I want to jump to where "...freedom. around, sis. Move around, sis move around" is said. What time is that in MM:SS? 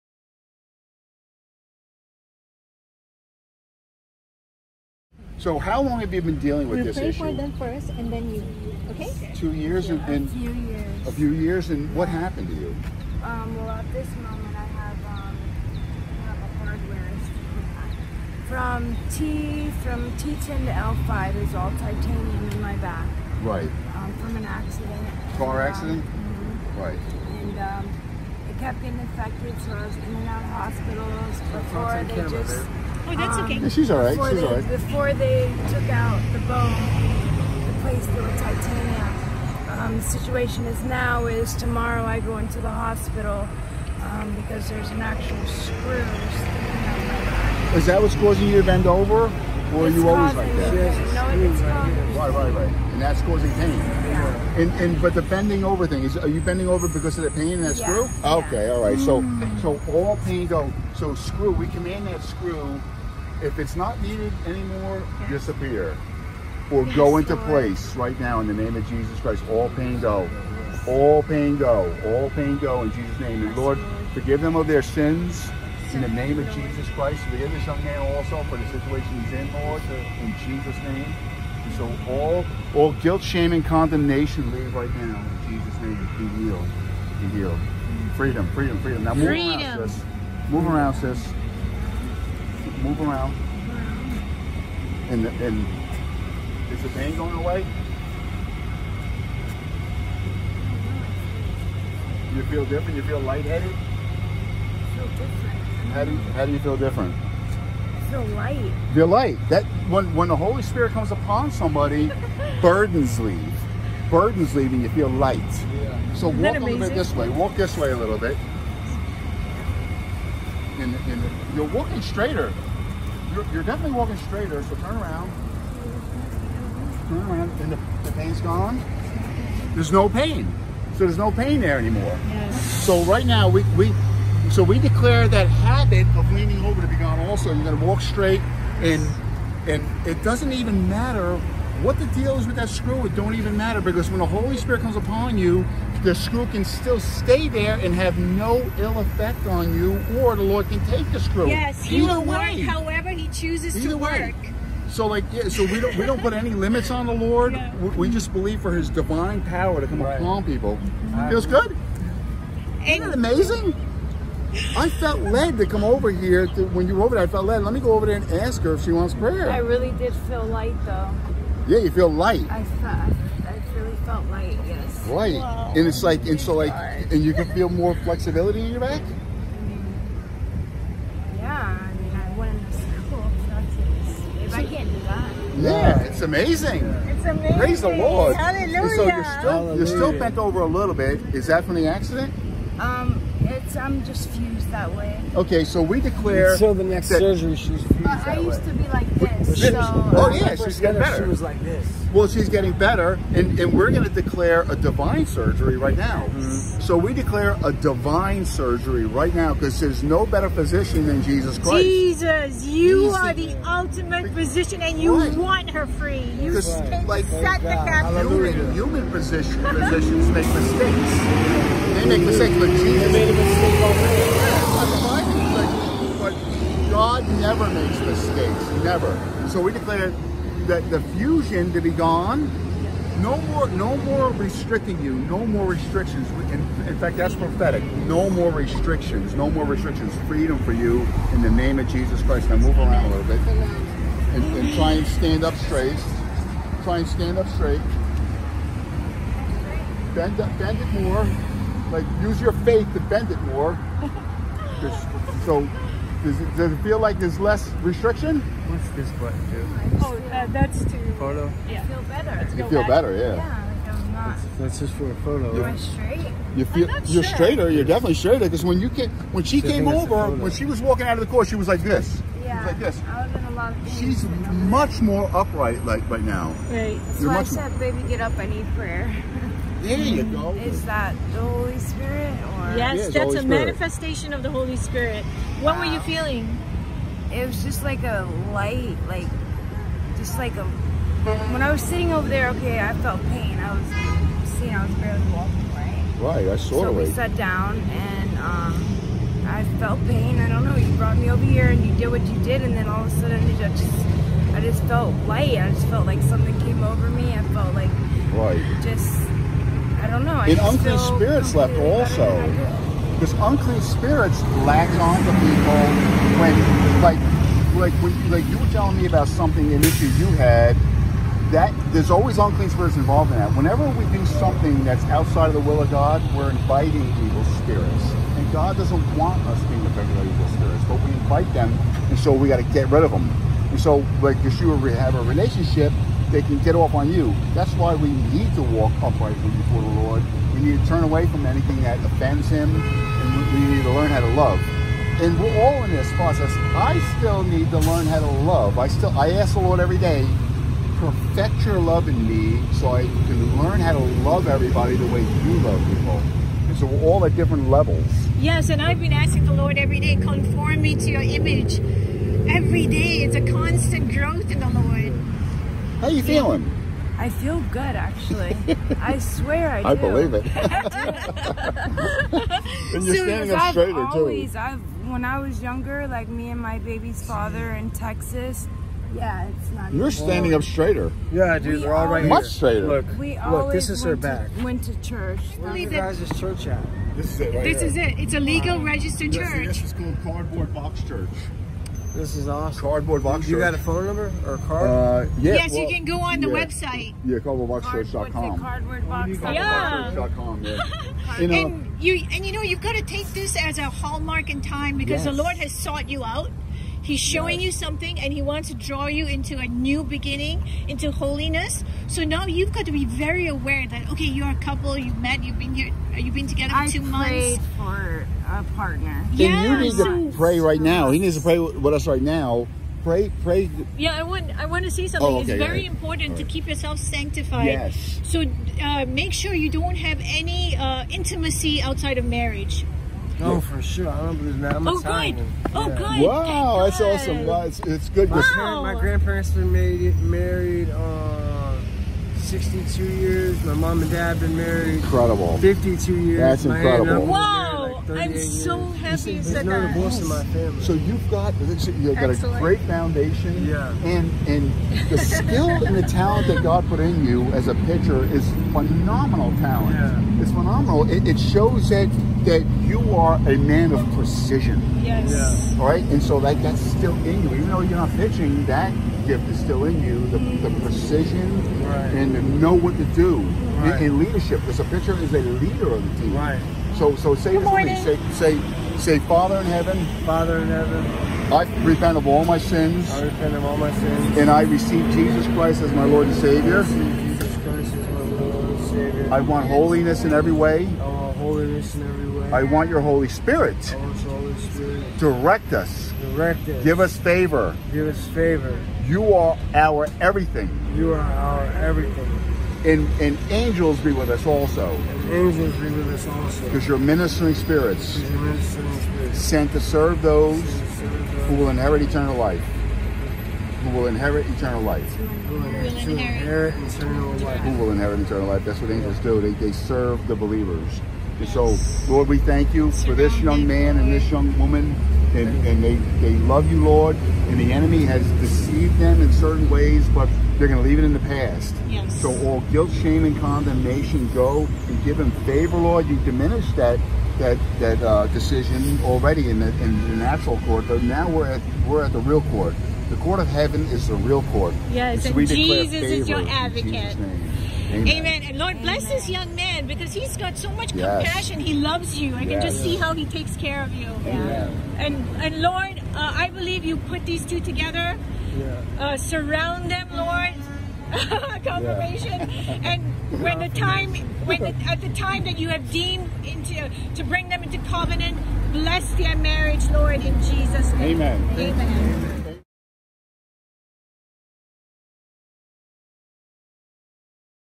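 01:29.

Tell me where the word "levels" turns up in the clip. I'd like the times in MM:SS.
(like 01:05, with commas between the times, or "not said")
05:57.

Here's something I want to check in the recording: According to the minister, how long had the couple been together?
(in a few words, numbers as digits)
2 months.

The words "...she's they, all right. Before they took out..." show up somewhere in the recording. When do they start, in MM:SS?
00:34.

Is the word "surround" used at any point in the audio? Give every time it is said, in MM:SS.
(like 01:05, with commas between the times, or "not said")
09:19.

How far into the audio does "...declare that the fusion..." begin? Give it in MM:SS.
03:49.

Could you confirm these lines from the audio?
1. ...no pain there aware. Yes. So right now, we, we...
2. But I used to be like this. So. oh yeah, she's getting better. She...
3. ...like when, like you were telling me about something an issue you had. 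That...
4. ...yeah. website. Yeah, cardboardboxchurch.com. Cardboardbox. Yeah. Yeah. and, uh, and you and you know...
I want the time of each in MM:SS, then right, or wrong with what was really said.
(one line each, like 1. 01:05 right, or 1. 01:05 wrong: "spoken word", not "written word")
1. 02:11 wrong: "anymore", not "aware"
2. 03:18 right
3. 05:17 right
4. 06:36 right.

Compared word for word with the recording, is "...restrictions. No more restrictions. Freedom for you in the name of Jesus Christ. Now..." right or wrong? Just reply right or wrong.
right.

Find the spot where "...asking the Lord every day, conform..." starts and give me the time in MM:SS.
05:59.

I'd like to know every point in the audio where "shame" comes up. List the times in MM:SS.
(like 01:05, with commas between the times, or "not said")
01:23, 08:53.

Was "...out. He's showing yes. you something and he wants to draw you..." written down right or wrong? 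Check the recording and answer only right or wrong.
right.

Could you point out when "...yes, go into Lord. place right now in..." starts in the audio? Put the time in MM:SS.
01:06.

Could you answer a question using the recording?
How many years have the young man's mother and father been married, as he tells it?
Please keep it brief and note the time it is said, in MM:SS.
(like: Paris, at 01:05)
52, at 07:25.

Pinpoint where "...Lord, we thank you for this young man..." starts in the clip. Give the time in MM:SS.
08:42.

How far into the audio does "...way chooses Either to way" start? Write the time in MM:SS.
02:32.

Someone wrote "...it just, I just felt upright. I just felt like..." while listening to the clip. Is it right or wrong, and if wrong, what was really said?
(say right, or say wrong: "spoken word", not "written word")
wrong: "light", not "upright".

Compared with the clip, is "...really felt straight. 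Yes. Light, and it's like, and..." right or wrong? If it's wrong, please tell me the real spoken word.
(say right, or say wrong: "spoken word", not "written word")
wrong: "light", not "straight".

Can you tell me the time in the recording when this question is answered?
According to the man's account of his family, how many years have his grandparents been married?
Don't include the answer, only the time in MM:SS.
07:22.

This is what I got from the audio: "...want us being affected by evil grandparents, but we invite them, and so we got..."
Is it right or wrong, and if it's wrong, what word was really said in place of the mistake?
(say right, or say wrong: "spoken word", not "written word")
wrong: "spirits", not "grandparents".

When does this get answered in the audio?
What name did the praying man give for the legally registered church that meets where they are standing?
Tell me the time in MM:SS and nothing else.
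06:30.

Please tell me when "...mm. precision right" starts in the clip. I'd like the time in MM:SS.
07:50.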